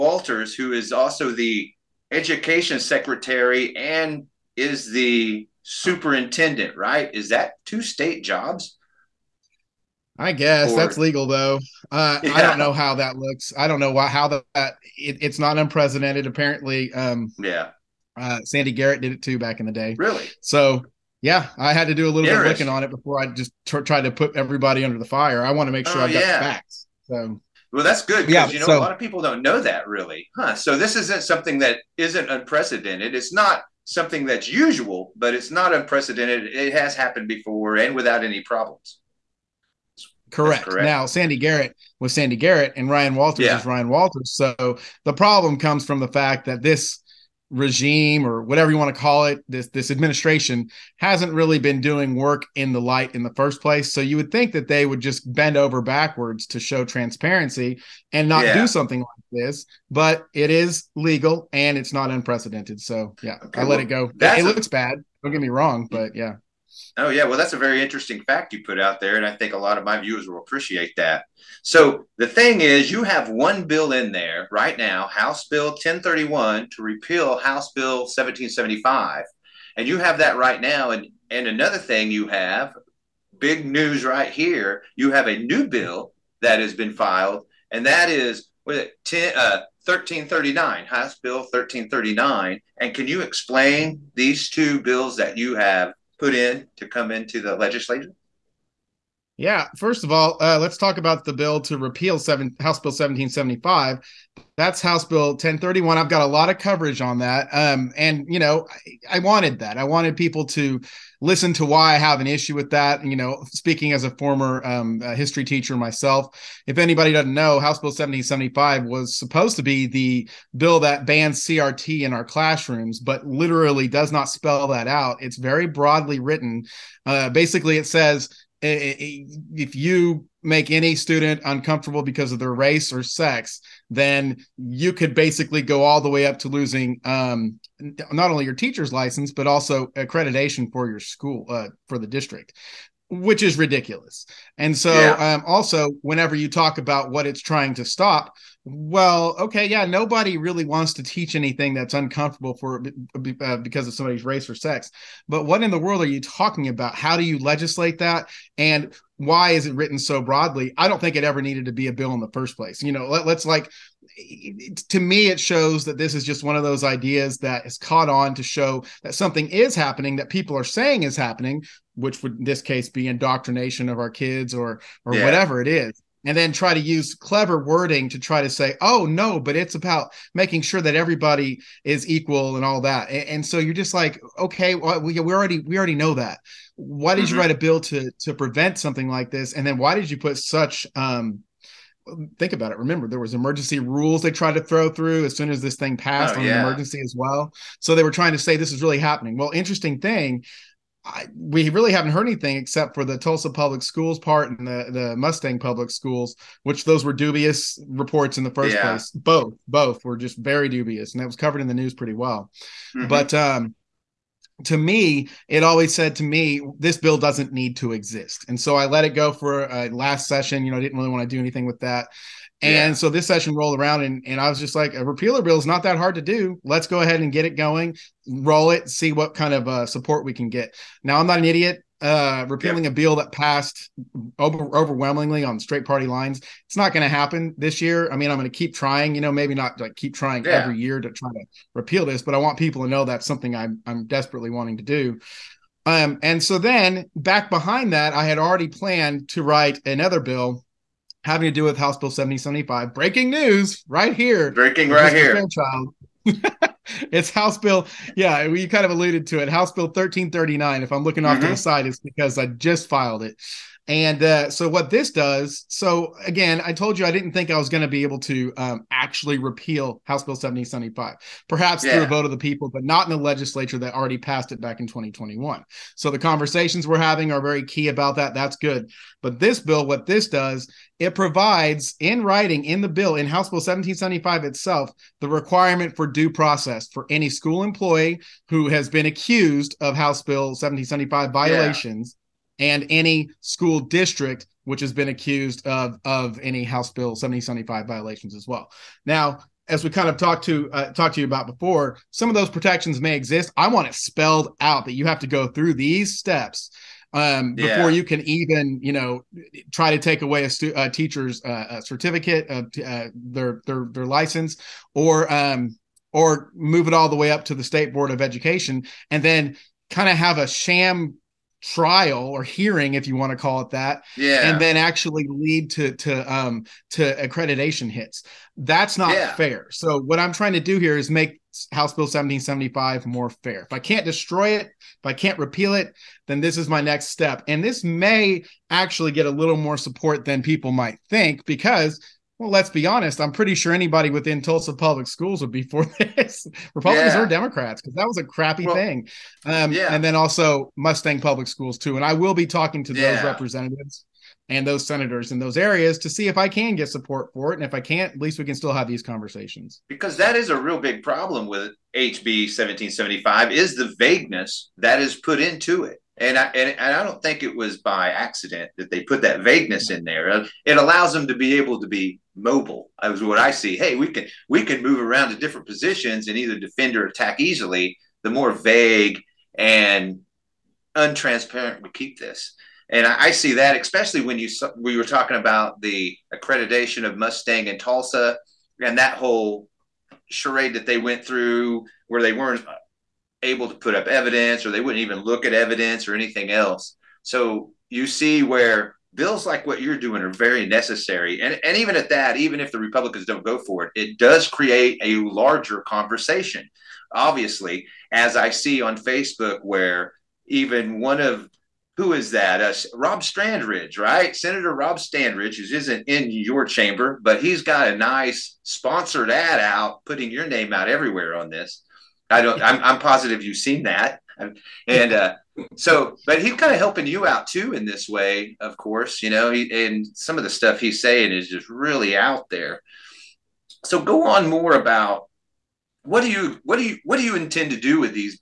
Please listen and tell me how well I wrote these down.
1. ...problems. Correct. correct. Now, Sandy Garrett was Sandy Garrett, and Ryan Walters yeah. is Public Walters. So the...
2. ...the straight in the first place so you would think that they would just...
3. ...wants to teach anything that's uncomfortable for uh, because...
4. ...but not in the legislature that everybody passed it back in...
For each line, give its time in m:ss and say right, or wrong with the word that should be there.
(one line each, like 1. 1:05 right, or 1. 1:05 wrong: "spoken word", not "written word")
1. 0:38 wrong: "Ryan", not "Public"
2. 0:52 wrong: "light", not "straight"
3. 2:30 right
4. 4:32 wrong: "already", not "everybody".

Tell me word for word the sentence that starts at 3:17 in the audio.
So they were trying to say this is really happening.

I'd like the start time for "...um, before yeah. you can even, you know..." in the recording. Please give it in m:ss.
5:07.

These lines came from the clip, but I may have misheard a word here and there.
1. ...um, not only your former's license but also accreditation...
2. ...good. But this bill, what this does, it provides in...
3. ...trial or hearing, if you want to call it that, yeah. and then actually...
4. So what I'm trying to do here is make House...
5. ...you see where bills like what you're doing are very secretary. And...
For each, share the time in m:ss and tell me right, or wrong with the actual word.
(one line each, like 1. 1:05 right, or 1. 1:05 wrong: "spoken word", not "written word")
1. 2:17 wrong: "teacher", not "former"
2. 4:38 right
3. 5:21 right
4. 5:29 right
5. 6:37 wrong: "necessary", not "secretary".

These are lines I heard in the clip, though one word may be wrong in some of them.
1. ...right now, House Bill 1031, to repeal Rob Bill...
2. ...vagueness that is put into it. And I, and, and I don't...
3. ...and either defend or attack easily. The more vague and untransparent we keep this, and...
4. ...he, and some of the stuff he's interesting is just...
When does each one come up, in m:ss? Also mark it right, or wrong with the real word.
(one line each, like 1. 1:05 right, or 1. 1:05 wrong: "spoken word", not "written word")
1. 1:14 wrong: "House", not "Rob"
2. 6:03 right
3. 6:16 right
4. 7:09 wrong: "saying", not "interesting".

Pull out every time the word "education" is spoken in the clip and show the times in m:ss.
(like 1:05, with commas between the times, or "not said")
0:02, 5:18.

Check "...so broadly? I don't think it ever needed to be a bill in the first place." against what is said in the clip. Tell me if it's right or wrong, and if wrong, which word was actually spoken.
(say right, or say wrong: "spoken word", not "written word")
right.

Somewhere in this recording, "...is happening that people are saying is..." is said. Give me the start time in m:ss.
2:49.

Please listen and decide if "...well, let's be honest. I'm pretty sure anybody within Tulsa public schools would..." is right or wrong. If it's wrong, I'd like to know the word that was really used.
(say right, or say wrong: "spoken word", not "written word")
right.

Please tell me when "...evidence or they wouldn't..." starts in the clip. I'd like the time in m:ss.
6:34.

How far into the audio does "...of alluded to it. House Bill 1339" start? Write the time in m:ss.
4:18.